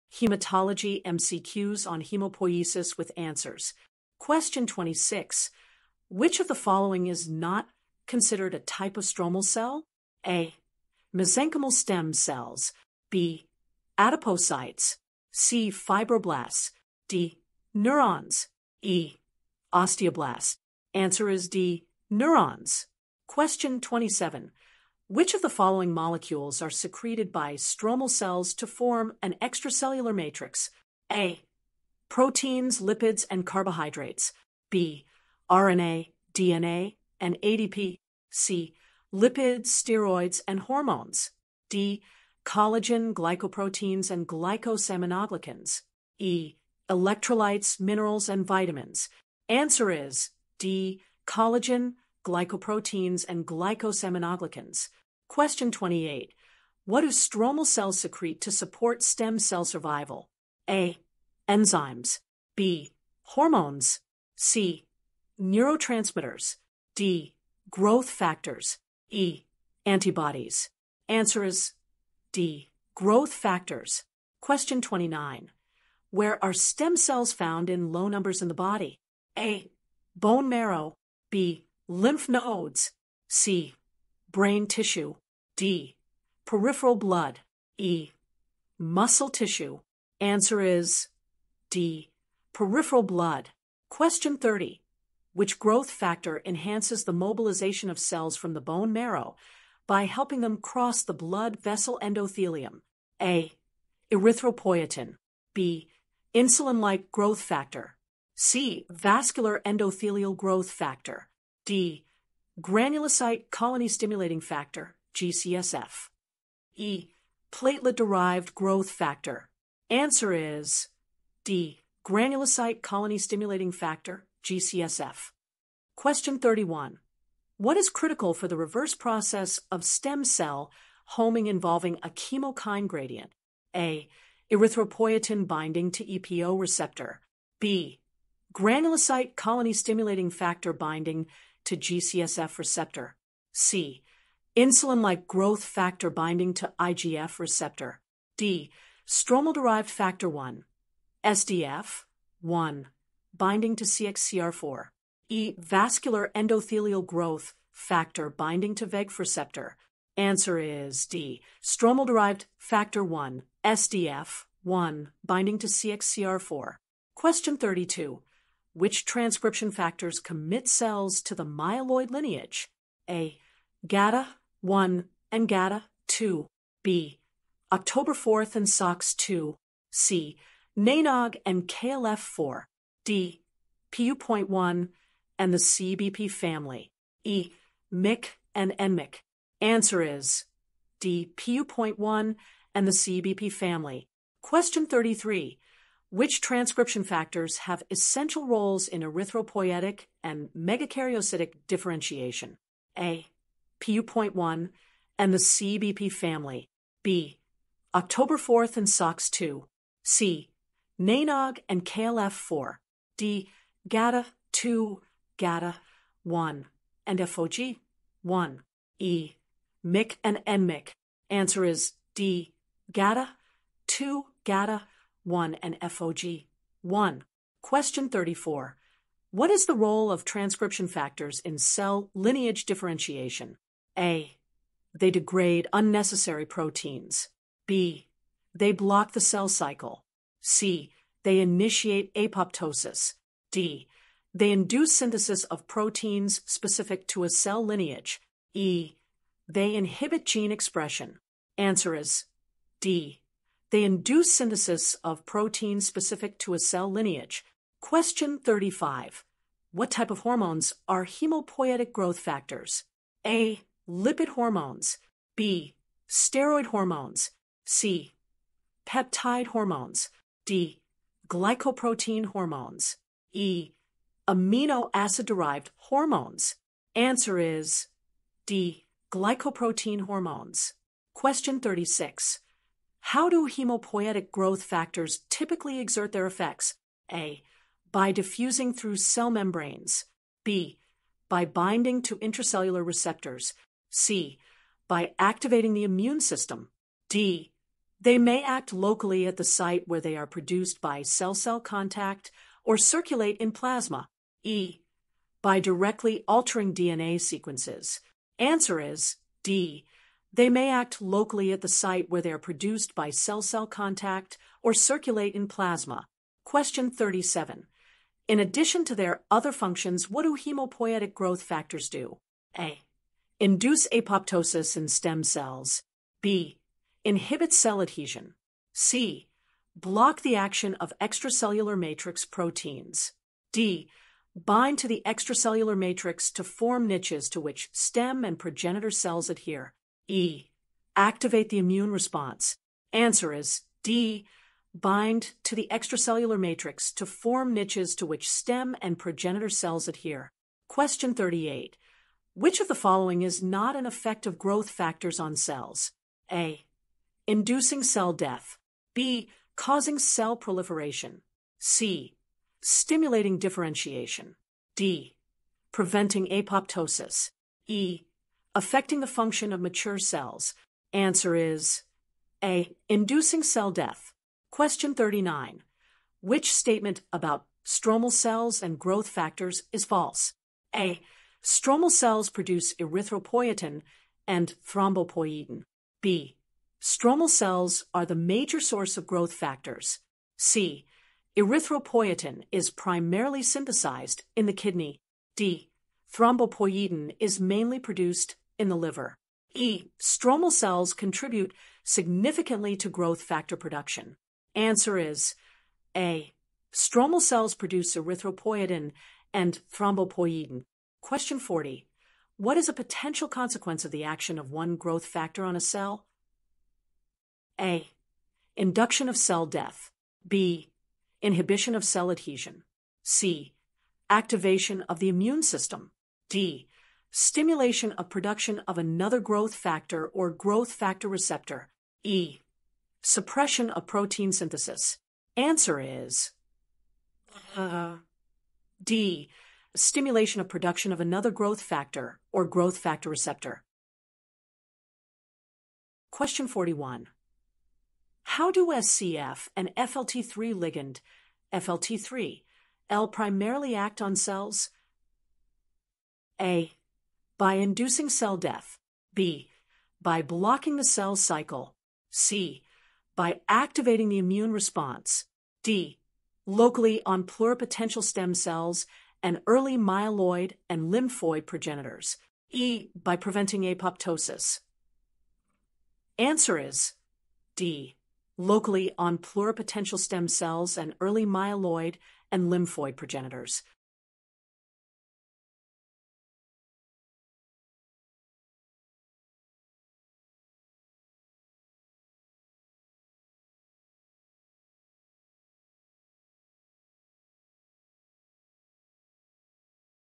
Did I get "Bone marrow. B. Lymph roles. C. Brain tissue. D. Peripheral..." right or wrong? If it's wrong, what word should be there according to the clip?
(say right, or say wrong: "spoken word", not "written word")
wrong: "nodes", not "roles".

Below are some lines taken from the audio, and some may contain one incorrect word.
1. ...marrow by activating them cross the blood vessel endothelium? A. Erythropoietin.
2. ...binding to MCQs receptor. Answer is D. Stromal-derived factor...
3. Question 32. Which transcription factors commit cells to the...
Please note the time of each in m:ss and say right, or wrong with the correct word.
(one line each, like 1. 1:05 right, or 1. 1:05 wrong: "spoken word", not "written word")
1. 1:38 wrong: "helping", not "activating"
2. 2:38 wrong: "VEGF", not "MCQs"
3. 2:47 right.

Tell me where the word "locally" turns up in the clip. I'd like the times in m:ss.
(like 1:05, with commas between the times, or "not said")
4:58, 5:11, 7:46, 7:58.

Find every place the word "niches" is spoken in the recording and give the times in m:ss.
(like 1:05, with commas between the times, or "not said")
5:36, 5:47.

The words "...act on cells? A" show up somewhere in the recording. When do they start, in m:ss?
7:33.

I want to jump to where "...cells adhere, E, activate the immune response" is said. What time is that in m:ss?
5:38.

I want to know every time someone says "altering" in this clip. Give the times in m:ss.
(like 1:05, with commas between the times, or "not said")
5:06.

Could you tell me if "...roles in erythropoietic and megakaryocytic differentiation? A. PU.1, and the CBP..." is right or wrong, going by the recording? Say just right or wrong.
right.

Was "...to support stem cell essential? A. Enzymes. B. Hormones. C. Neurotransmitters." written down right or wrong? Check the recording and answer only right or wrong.
wrong.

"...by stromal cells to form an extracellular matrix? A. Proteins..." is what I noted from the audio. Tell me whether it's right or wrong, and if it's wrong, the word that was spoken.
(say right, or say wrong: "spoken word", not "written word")
right.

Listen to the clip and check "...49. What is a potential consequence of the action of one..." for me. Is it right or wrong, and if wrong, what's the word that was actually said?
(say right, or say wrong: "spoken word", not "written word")
wrong: "40", not "49".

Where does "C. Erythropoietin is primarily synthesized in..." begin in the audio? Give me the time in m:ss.
6:30.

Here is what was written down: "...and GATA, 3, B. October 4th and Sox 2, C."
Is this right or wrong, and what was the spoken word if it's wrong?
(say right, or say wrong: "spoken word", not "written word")
wrong: "2", not "3".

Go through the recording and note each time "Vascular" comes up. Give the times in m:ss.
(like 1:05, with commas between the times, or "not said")
1:48, 2:35.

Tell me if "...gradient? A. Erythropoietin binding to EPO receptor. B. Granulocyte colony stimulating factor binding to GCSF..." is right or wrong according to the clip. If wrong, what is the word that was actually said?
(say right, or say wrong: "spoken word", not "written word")
right.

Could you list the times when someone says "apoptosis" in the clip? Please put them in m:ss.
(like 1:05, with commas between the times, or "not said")
4:02, 5:23, 6:06, 7:53.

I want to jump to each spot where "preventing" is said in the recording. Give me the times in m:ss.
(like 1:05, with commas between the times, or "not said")
6:05, 7:53.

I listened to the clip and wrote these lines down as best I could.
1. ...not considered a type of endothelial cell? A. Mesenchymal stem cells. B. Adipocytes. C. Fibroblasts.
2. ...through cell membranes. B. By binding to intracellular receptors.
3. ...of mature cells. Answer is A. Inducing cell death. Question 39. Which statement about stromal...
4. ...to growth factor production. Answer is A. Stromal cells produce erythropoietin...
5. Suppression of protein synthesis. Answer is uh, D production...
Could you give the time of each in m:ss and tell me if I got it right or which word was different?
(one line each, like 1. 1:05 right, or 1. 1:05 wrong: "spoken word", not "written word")
1. 0:07 wrong: "stromal", not "endothelial"
2. 4:48 right
3. 6:09 right
4. 6:42 right
5. 7:13 wrong: "stimulation", not "production".